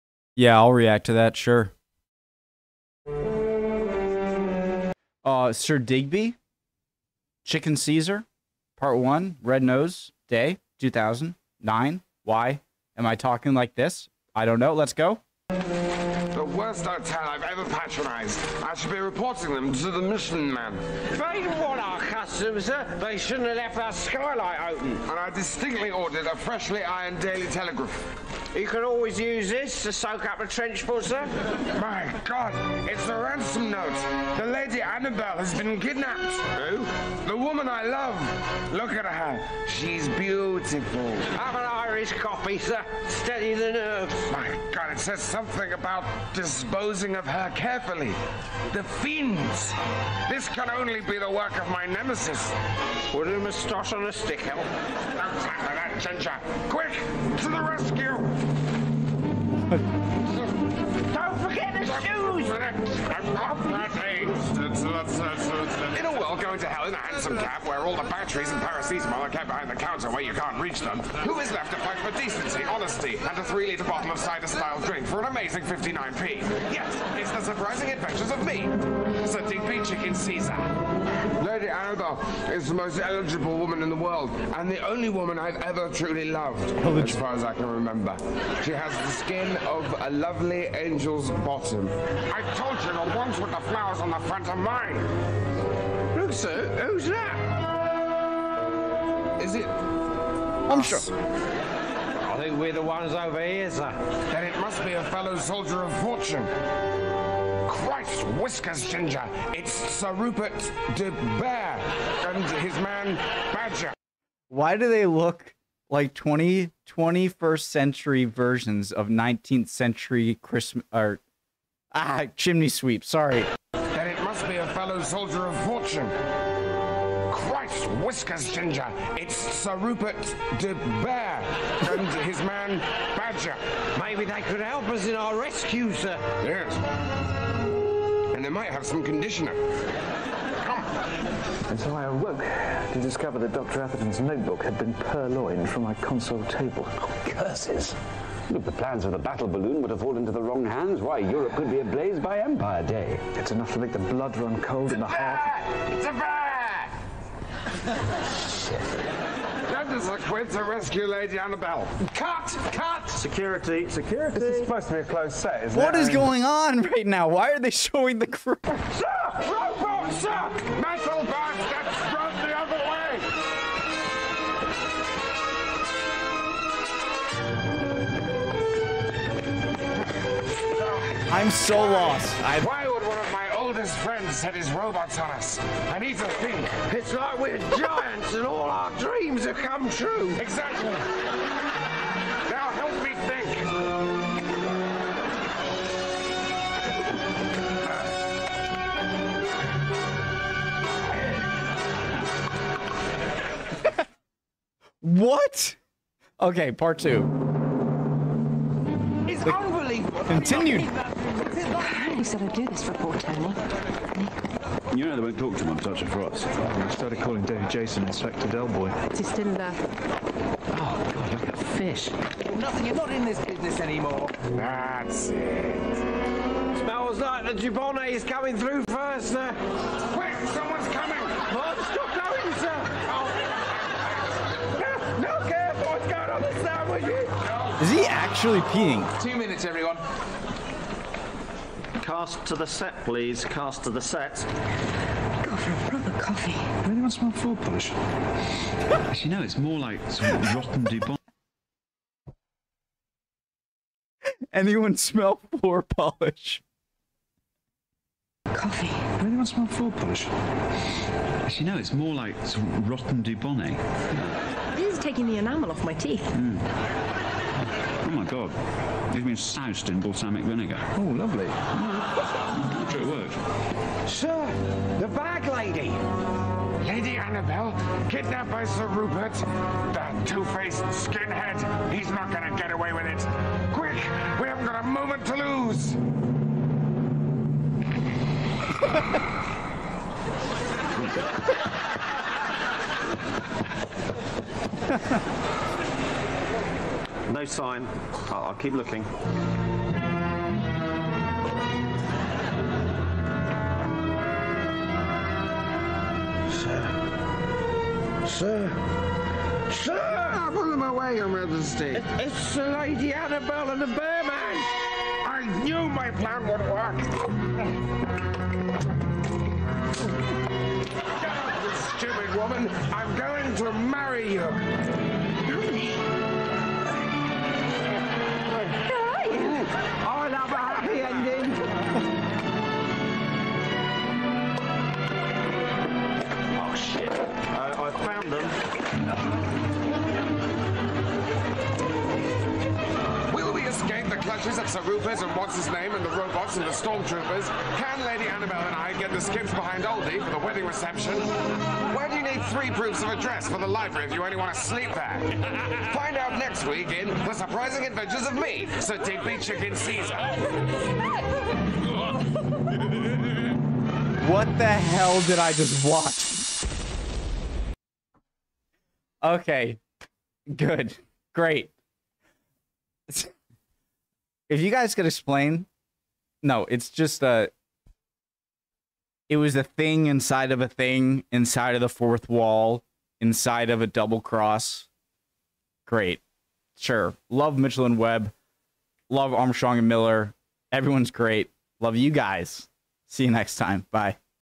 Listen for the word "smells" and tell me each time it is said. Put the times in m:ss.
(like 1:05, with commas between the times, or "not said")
3:46, 4:14.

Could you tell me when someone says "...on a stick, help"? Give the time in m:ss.
0:53.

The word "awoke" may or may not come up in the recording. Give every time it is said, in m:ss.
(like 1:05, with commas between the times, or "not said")
2:22.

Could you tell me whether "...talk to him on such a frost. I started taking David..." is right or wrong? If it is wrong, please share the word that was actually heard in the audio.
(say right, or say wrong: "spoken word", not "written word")
wrong: "calling", not "taking".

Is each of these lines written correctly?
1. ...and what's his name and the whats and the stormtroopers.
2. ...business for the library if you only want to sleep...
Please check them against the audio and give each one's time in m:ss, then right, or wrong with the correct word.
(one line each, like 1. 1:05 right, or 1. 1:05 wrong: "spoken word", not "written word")
1. 5:45 wrong: "robots", not "whats"
2. 5:53 wrong: "address", not "business".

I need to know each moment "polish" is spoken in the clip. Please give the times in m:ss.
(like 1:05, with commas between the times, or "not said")
4:07, 4:15, 4:19.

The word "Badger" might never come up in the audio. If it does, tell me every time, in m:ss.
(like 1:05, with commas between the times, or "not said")
1:53, 2:13.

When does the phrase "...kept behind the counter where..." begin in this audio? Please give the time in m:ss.
1:09.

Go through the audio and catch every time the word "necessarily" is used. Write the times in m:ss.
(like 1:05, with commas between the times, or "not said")
not said.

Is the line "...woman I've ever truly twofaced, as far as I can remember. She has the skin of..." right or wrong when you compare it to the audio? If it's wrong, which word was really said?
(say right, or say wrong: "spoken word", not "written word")
wrong: "loved", not "twofaced".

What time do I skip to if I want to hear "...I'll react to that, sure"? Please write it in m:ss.
0:00.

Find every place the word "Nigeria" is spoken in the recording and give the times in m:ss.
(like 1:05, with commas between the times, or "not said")
not said.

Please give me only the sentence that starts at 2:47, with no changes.
Why are they showing the crew?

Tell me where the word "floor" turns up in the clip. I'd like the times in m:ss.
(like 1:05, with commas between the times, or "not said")
4:07, 4:15, 4:19.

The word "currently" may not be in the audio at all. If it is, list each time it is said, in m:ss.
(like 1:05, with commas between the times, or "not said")
not said.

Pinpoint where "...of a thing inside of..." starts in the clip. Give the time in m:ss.
6:20.